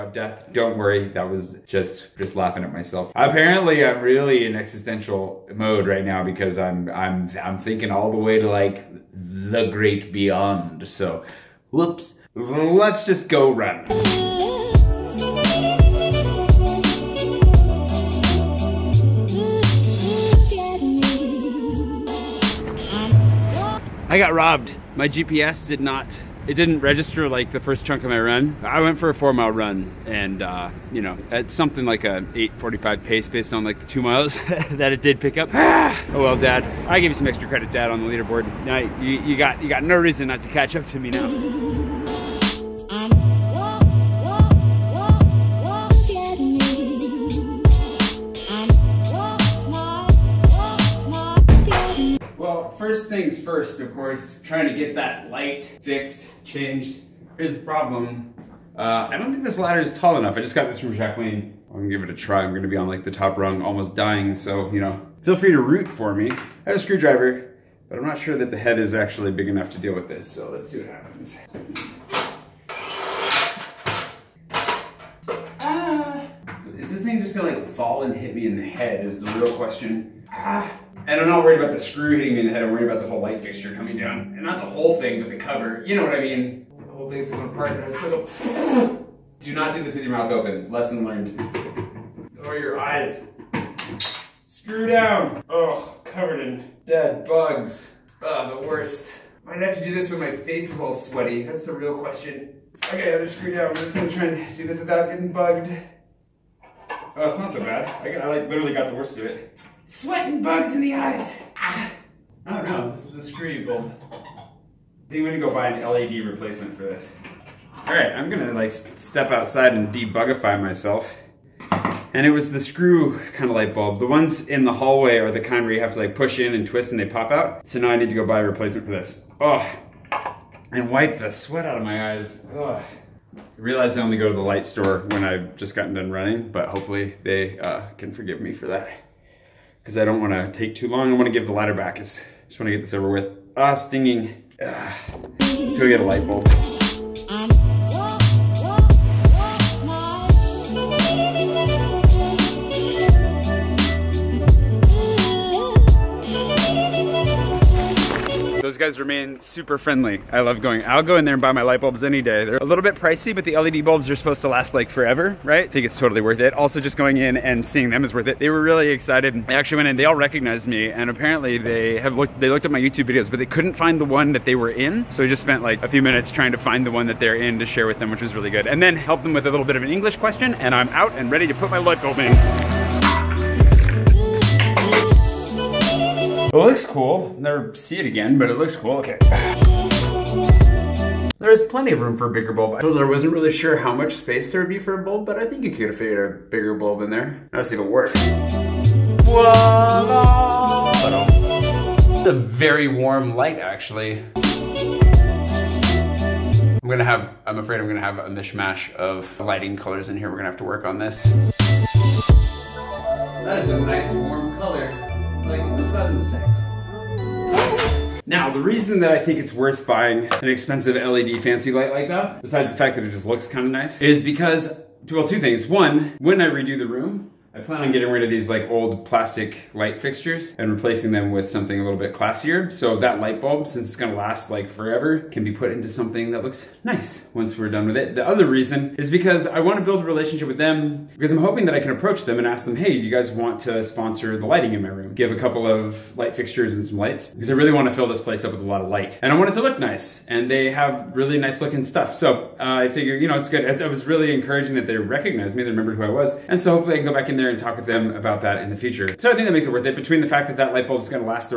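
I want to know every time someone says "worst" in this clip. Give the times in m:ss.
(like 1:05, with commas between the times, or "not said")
1:38, 1:48.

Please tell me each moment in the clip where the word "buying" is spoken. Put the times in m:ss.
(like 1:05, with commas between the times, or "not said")
3:39.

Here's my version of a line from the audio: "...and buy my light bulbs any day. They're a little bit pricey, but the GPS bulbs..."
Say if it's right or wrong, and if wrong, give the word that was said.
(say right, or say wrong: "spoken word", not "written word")
wrong: "LED", not "GPS".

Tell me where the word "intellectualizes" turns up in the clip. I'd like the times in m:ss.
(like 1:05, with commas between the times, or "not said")
not said.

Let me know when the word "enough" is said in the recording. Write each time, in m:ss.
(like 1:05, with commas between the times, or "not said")
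1:00, 1:09.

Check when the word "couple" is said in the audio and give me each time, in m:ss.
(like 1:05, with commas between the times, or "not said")
4:05.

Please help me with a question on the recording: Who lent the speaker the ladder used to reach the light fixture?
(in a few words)
Jacqueline.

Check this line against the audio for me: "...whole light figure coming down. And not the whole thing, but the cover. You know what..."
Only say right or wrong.
wrong.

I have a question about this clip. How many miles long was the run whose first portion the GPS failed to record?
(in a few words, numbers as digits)
4.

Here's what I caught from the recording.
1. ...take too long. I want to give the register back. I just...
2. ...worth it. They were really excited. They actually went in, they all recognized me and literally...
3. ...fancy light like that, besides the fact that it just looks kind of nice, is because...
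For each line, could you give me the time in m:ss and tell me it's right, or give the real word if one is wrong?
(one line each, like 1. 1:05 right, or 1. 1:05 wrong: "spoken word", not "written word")
1. 2:20 wrong: "lighter", not "register"
2. 2:48 wrong: "apparently", not "literally"
3. 3:41 right.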